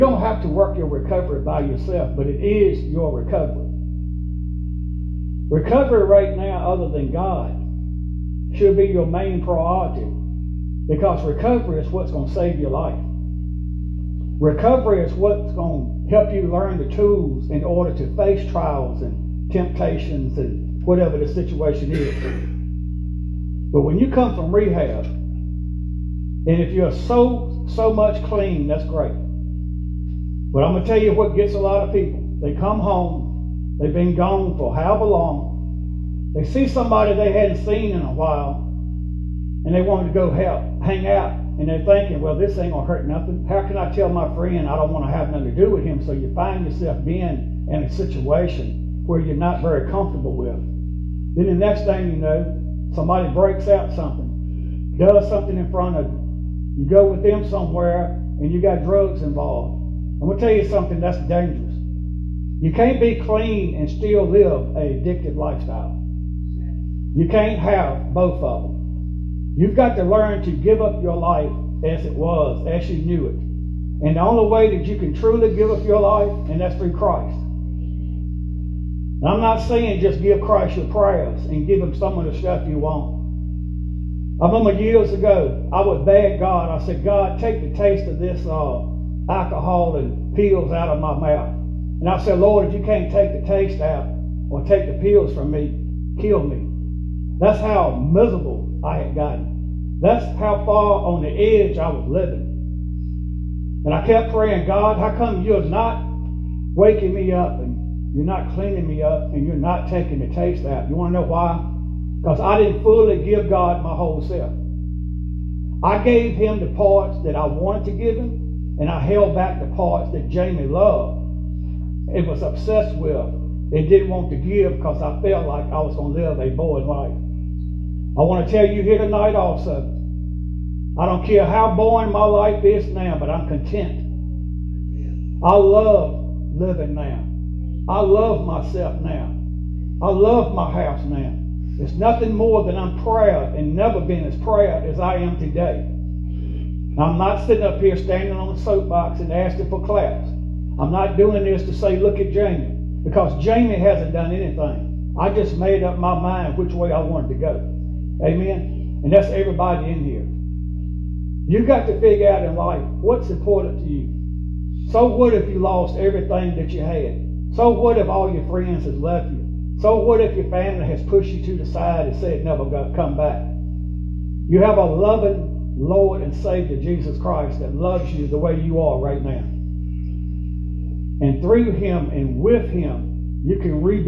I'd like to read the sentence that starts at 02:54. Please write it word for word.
You have a loving Lord and Savior, Jesus Christ, that loves you the way you are right now.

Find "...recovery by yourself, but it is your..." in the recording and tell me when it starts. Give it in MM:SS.
00:00.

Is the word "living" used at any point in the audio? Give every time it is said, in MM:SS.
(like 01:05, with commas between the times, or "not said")
01:42, 02:16.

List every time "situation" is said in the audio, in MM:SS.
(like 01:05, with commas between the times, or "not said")
00:21, 00:47.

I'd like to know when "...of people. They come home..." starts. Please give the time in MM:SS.
00:31.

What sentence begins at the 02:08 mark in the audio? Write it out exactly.
I want to tell you here tonight also, I don't care how boring my life is now, but I'm content.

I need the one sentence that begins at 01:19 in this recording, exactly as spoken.
I'm not saying just give Christ your prayers and give him some of the stuff you want.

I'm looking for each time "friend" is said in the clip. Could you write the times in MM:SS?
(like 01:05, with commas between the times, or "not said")
00:44, 02:48.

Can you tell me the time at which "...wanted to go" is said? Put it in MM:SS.
02:37.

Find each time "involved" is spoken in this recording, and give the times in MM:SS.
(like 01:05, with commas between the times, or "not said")
00:59.